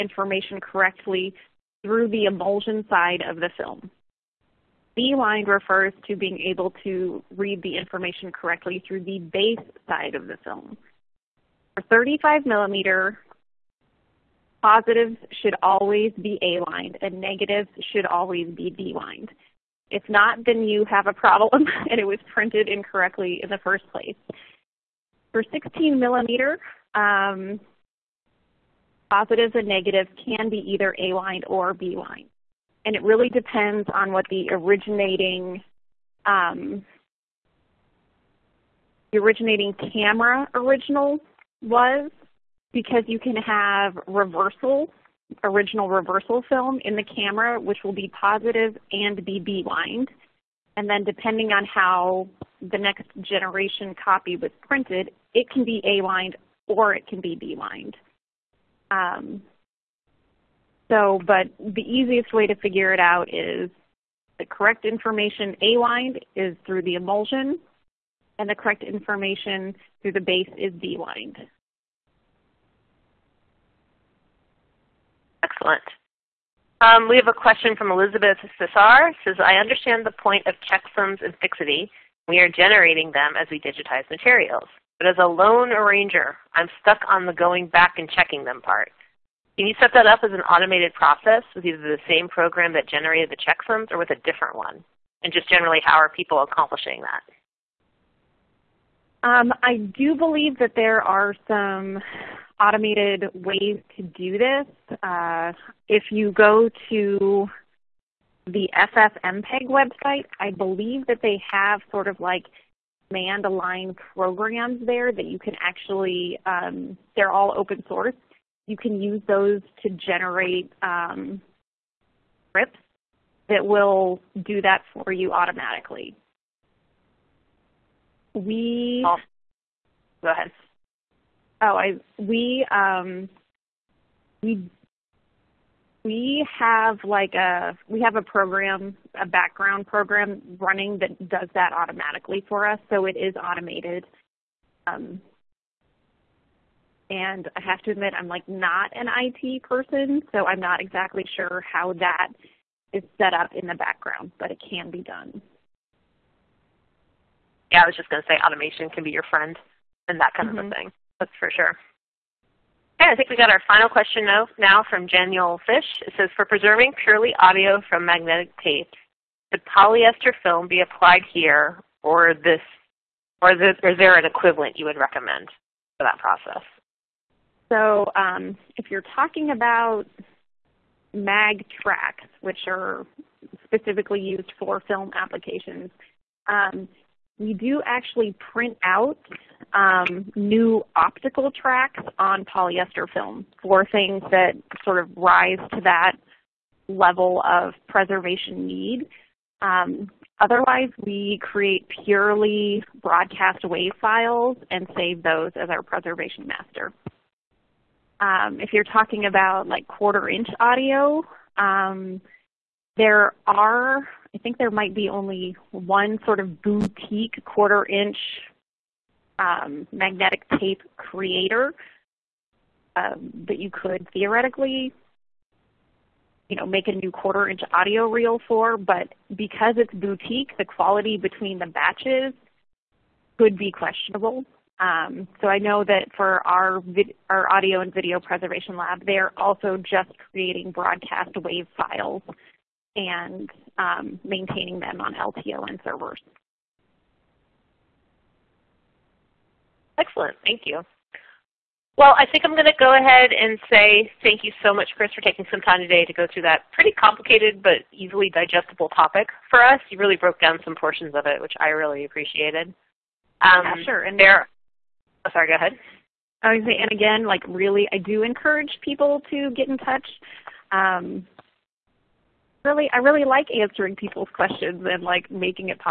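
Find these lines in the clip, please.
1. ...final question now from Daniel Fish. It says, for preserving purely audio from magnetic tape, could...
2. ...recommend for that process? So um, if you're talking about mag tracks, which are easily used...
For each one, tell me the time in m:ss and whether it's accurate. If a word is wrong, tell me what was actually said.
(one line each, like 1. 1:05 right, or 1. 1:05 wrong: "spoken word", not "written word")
1. 2:43 right
2. 2:54 wrong: "specifically", not "easily".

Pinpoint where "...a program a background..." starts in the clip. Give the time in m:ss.
2:18.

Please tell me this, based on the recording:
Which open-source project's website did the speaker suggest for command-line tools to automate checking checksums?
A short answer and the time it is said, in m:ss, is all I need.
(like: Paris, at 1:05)
FFmpeg, at 1:48.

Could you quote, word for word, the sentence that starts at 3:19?
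Um, otherwise, we create purely broadcast wave files and save those as our preservation master.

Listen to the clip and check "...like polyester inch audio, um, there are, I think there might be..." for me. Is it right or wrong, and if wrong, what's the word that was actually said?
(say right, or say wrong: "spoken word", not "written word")
wrong: "quarter", not "polyester".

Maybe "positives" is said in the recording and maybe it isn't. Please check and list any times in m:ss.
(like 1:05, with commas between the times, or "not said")
0:14, 0:29, 0:48.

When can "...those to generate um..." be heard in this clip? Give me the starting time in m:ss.
1:59.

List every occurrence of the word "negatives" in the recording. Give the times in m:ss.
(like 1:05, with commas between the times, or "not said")
0:17, 0:29.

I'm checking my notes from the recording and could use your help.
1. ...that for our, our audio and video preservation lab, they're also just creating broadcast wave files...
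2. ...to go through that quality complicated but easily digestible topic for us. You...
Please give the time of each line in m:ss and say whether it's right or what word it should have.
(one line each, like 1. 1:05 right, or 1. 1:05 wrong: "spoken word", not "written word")
1. 3:55 right
2. 4:16 wrong: "pretty", not "quality".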